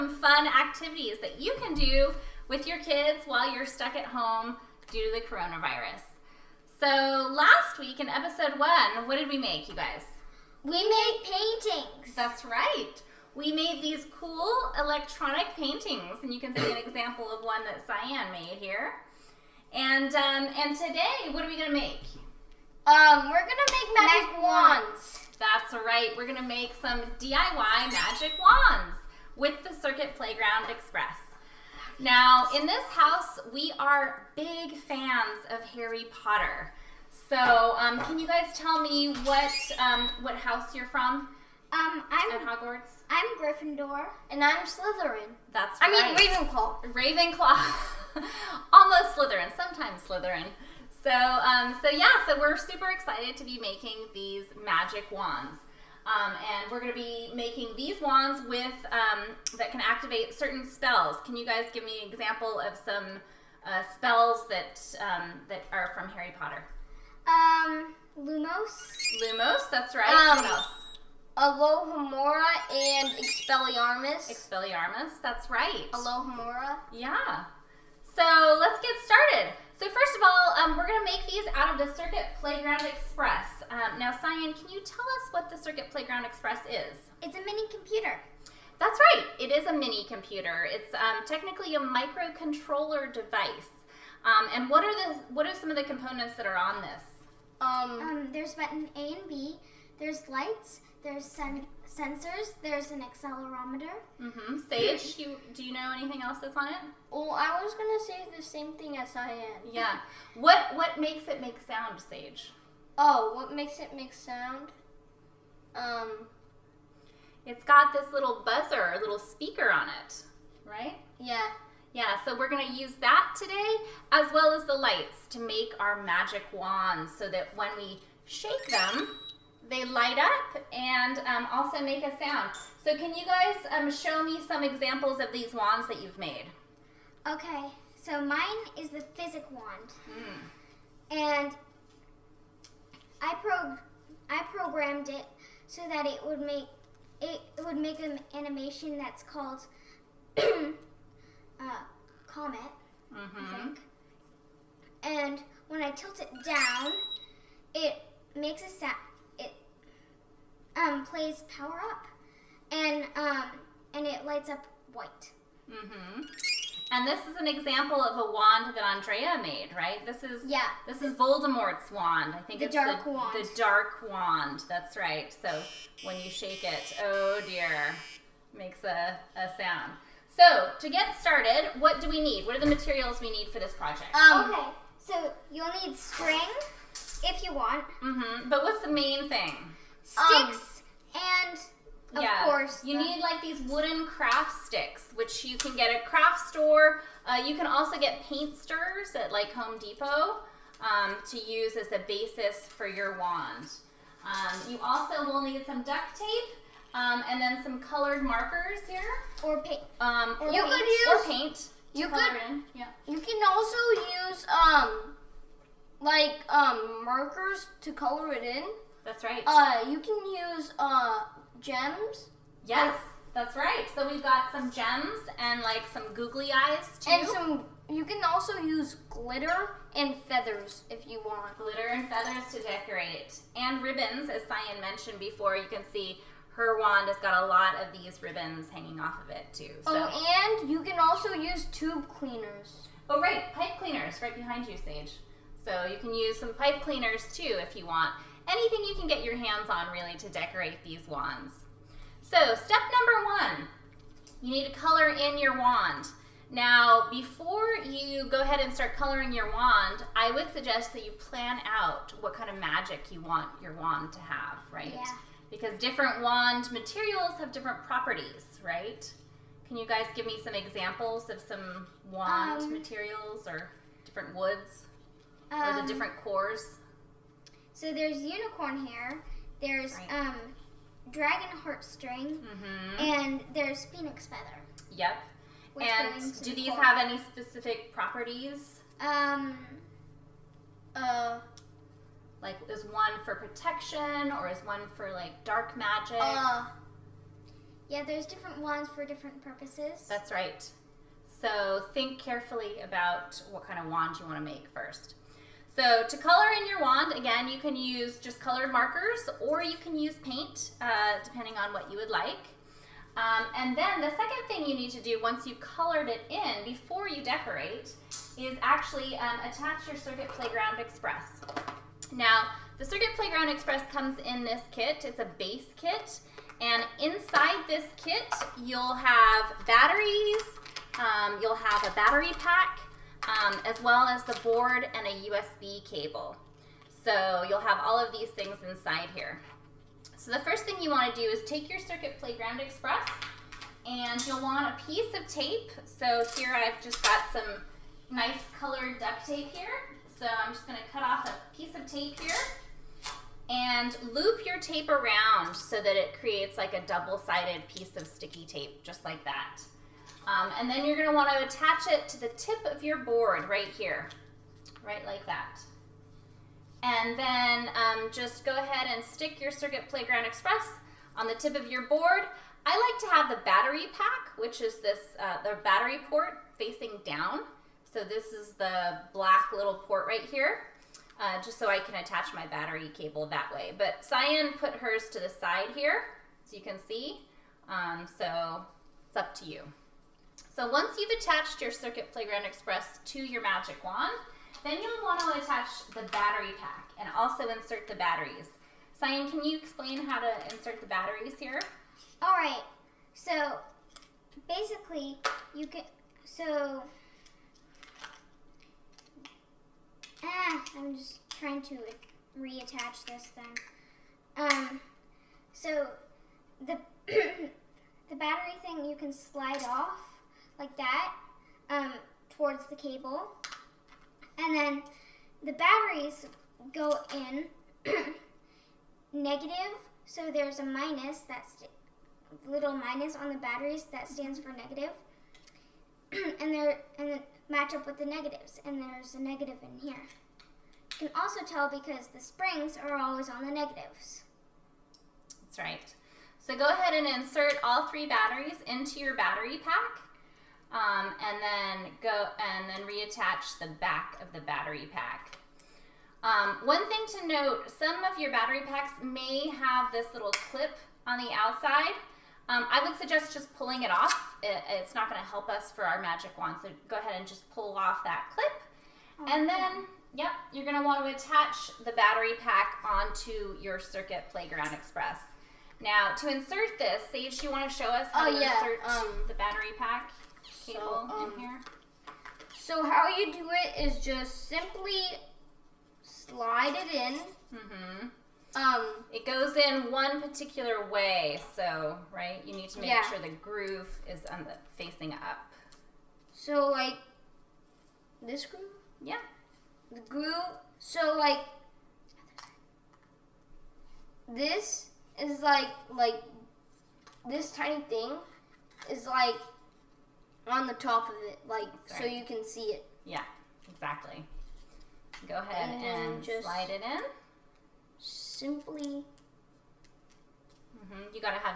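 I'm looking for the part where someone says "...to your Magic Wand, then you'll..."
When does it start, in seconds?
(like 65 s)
393 s.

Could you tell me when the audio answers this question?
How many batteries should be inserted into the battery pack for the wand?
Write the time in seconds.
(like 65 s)
447 s.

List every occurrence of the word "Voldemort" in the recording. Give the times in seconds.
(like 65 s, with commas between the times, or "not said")
171 s.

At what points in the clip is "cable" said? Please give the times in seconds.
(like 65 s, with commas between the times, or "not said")
335 s, 382 s, 422 s.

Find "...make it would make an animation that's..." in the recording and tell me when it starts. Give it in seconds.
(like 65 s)
146 s.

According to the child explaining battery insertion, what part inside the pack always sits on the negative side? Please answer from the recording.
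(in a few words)
springs.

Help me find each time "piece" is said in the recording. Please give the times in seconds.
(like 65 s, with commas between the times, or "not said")
344 s, 351 s, 357 s.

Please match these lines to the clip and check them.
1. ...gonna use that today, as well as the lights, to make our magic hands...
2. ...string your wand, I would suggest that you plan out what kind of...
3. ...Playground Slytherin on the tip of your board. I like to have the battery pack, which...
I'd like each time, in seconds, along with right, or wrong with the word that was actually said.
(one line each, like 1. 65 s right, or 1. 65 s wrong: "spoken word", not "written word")
1. 122 s wrong: "wands", not "hands"
2. 258 s wrong: "coloring", not "string"
3. 369 s wrong: "Express", not "Slytherin".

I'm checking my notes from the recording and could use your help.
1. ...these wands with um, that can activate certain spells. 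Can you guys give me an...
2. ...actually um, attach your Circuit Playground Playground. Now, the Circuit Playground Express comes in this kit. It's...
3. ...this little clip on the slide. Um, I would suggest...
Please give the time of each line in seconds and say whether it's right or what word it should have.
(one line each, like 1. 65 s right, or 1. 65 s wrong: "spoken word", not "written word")
1. 57 s right
2. 318 s wrong: "Express", not "Playground"
3. 459 s wrong: "outside", not "slide".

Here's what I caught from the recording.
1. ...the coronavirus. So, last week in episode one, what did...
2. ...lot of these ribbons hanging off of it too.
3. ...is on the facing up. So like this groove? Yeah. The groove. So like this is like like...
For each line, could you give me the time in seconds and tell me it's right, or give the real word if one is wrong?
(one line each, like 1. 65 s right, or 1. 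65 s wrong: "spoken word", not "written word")
1. 5 s right
2. 237 s right
3. 494 s right.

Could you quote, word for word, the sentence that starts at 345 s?
So here I've just got some nice colored duct tape here.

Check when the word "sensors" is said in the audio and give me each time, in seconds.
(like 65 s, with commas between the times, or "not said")
101 s.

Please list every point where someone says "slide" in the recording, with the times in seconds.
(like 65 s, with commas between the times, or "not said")
419 s, 486 s, 516 s.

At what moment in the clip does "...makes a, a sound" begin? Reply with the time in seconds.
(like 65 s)
178 s.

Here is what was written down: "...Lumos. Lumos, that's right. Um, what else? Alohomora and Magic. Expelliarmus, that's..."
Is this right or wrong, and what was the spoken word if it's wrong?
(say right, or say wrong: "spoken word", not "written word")
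wrong: "Expelliarmus", not "Magic".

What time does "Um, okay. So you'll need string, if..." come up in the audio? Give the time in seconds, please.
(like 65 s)
184 s.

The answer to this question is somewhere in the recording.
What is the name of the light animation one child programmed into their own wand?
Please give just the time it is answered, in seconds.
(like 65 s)
152 s.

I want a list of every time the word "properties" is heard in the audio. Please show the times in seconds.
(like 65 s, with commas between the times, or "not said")
267 s, 287 s.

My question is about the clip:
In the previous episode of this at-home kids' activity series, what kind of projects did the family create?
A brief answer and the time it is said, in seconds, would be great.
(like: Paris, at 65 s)
electronic paintings, at 14 s.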